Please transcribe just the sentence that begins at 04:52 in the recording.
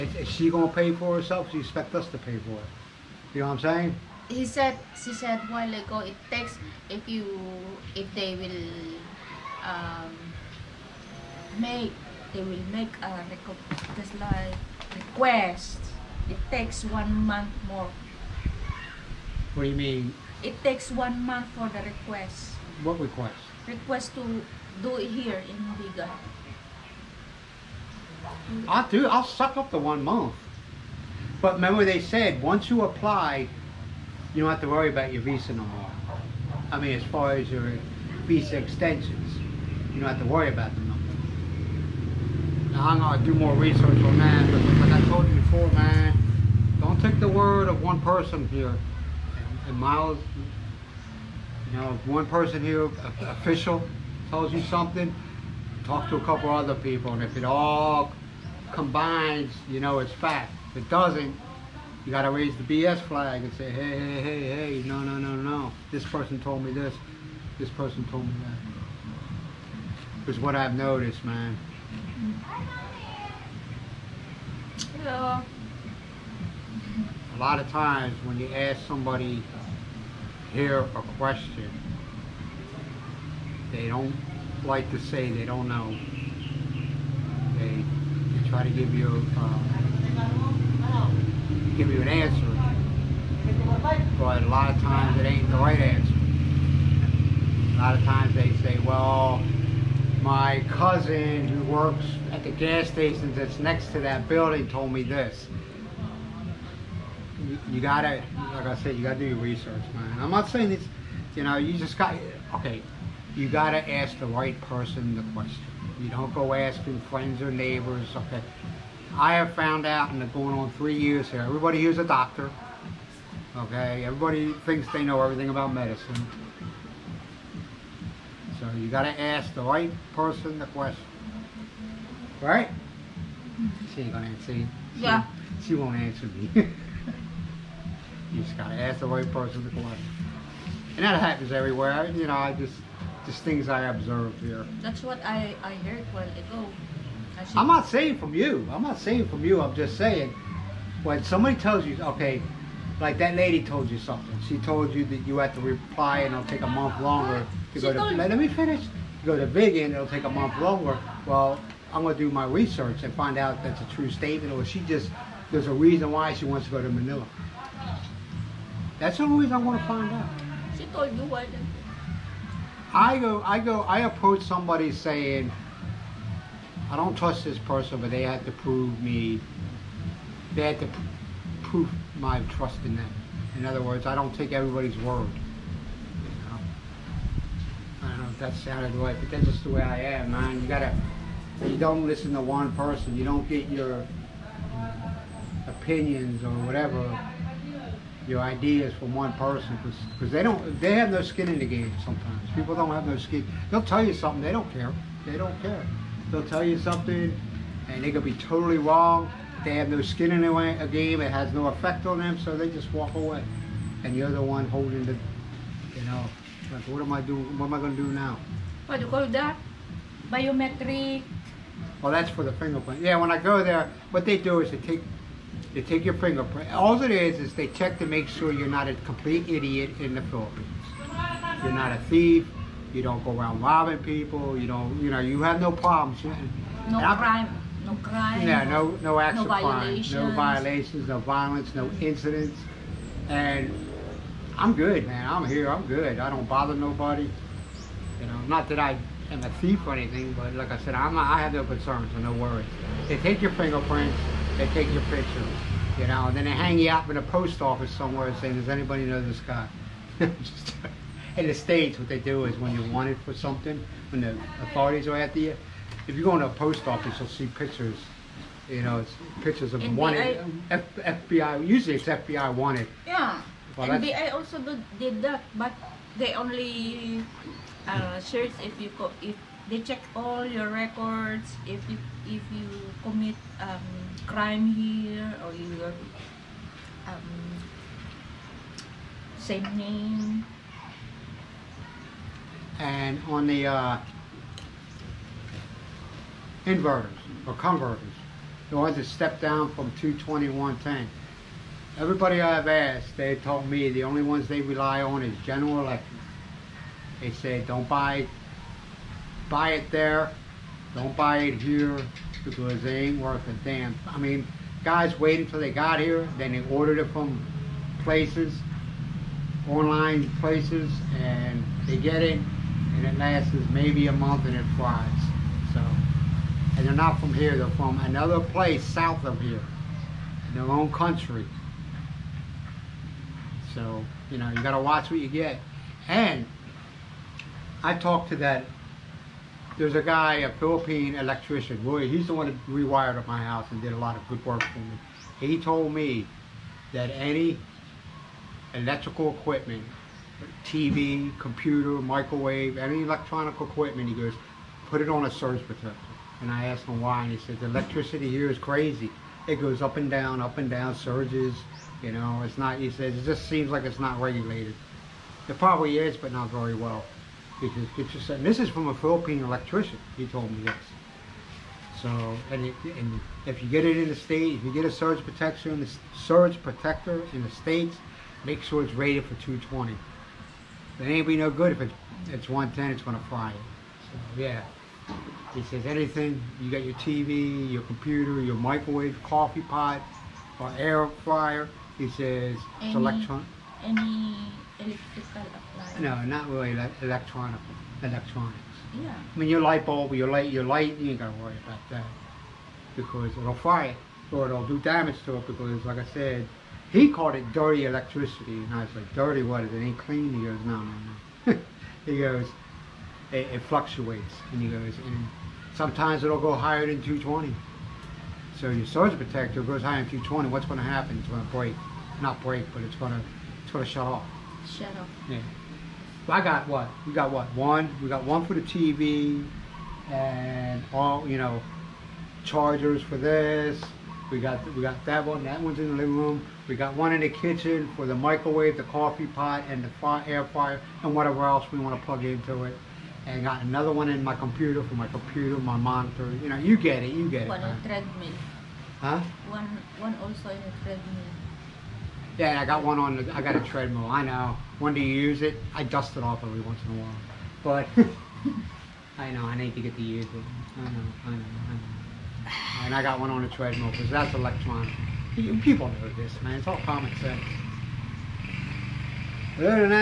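And on the uh, inverters or converters, the ones that step down from 22110.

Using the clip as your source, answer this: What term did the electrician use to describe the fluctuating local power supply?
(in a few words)
Dirty electricity.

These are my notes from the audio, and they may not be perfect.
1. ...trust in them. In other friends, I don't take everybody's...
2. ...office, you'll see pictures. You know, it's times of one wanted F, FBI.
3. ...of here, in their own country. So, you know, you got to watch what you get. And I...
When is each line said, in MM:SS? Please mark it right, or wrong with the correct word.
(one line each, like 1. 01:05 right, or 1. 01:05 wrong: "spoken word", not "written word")
1. 03:02 wrong: "words", not "friends"
2. 04:26 wrong: "pictures", not "times"
3. 05:29 right.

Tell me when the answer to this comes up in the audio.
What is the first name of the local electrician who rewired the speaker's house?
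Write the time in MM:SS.
05:41.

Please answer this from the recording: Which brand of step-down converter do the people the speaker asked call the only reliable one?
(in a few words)
General Electric.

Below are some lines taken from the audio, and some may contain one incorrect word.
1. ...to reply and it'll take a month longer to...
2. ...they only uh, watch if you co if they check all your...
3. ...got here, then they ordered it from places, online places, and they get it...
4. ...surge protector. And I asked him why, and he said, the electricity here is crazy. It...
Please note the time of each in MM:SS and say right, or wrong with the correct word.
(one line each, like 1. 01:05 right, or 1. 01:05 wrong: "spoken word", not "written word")
1. 02:35 right
2. 04:36 wrong: "search", not "watch"
3. 05:15 right
4. 05:55 right.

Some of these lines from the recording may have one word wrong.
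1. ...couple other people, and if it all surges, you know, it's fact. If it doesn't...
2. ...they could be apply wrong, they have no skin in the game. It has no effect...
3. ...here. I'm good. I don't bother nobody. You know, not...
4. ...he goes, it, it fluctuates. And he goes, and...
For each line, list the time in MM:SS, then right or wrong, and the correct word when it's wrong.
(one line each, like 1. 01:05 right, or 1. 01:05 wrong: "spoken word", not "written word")
1. 00:56 wrong: "combines", not "surges"
2. 03:28 wrong: "totally", not "apply"
3. 04:05 right
4. 06:52 right.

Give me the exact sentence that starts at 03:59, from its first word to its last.
No violations, no violence, no incidents.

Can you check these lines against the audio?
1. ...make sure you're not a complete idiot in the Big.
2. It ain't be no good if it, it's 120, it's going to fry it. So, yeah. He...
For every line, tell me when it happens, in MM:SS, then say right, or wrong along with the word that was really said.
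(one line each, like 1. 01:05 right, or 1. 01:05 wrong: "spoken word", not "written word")
1. 03:48 wrong: "Philippines", not "Big"
2. 06:20 wrong: "110", not "120".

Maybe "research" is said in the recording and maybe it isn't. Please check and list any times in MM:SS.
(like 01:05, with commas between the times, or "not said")
00:43, 01:49, 02:42.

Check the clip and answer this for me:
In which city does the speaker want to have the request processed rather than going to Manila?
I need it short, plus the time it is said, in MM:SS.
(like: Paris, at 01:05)
Vigan, at 00:25.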